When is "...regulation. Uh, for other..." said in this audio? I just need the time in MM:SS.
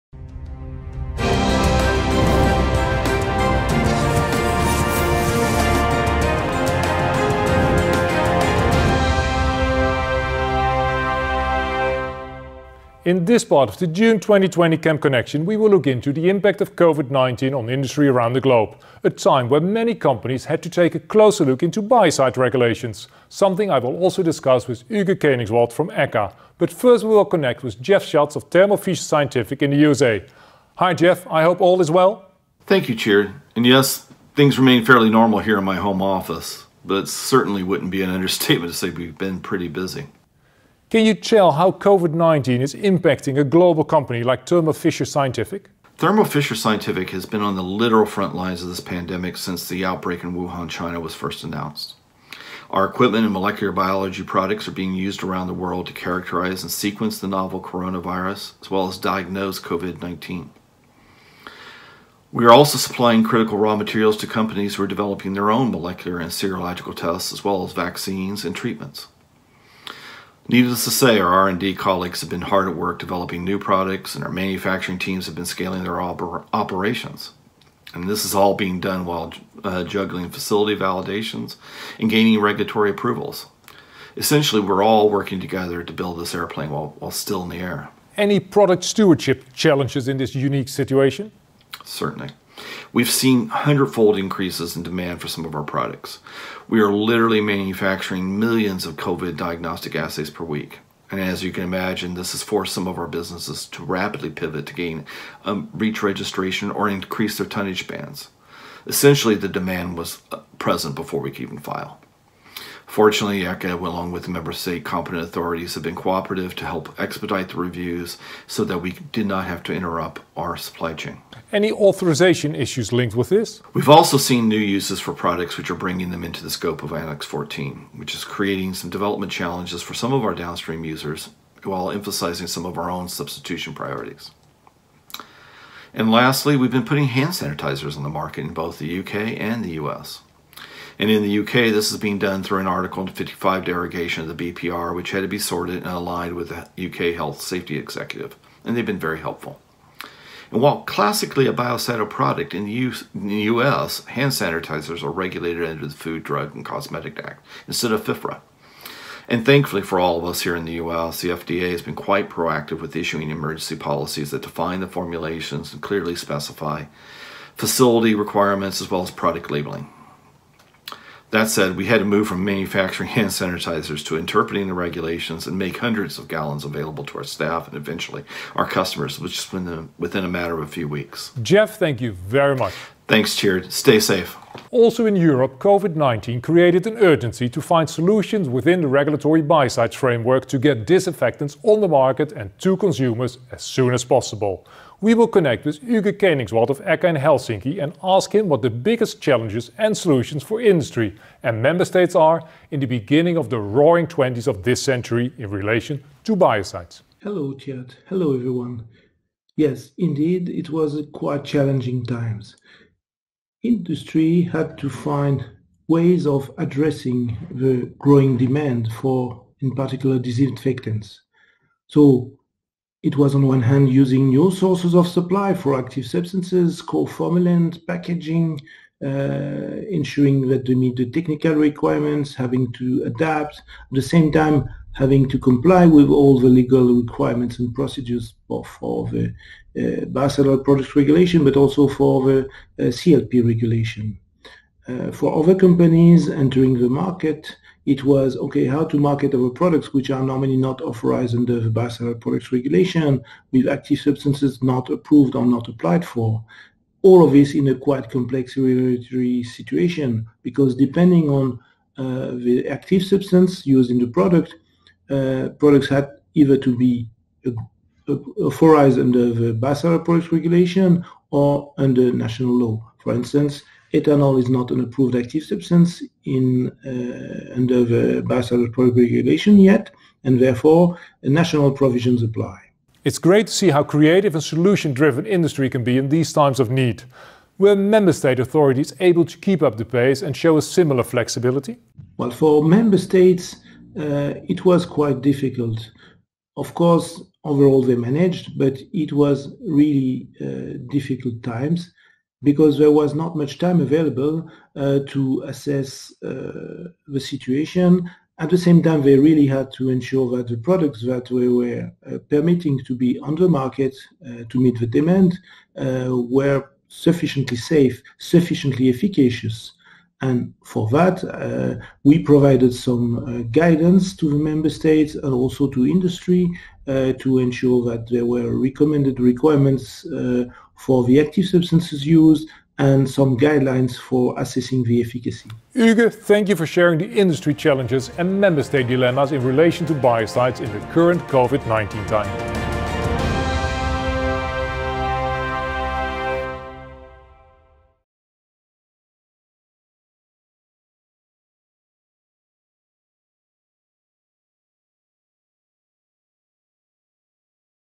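04:03.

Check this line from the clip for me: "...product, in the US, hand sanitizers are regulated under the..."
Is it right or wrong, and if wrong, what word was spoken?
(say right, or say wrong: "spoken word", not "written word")
right.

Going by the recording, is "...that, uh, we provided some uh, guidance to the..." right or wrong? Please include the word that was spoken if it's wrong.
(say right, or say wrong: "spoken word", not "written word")
right.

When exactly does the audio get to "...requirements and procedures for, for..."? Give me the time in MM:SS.
03:56.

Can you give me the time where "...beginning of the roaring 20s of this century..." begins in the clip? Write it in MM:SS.
03:22.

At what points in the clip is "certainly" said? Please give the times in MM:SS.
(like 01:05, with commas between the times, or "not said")
00:37, 01:31.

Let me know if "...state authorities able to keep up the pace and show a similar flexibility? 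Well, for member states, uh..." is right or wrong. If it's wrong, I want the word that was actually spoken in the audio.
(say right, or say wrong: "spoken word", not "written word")
right.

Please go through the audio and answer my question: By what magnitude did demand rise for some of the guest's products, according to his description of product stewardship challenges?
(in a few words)
Hundredfold.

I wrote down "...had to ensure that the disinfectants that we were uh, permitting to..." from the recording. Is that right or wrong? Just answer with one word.
wrong.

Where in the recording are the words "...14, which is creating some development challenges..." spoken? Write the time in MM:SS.
02:07.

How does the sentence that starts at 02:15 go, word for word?
And lastly, we've been putting hand sanitizers on the market in both the UK and the US.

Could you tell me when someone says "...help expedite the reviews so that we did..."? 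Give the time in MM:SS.
01:56.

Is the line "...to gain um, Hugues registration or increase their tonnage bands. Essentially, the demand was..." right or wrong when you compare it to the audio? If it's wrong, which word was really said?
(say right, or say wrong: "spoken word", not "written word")
wrong: "REACH", not "Hugues".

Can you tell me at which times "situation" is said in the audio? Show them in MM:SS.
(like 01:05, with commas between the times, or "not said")
01:30, 04:19, 05:07.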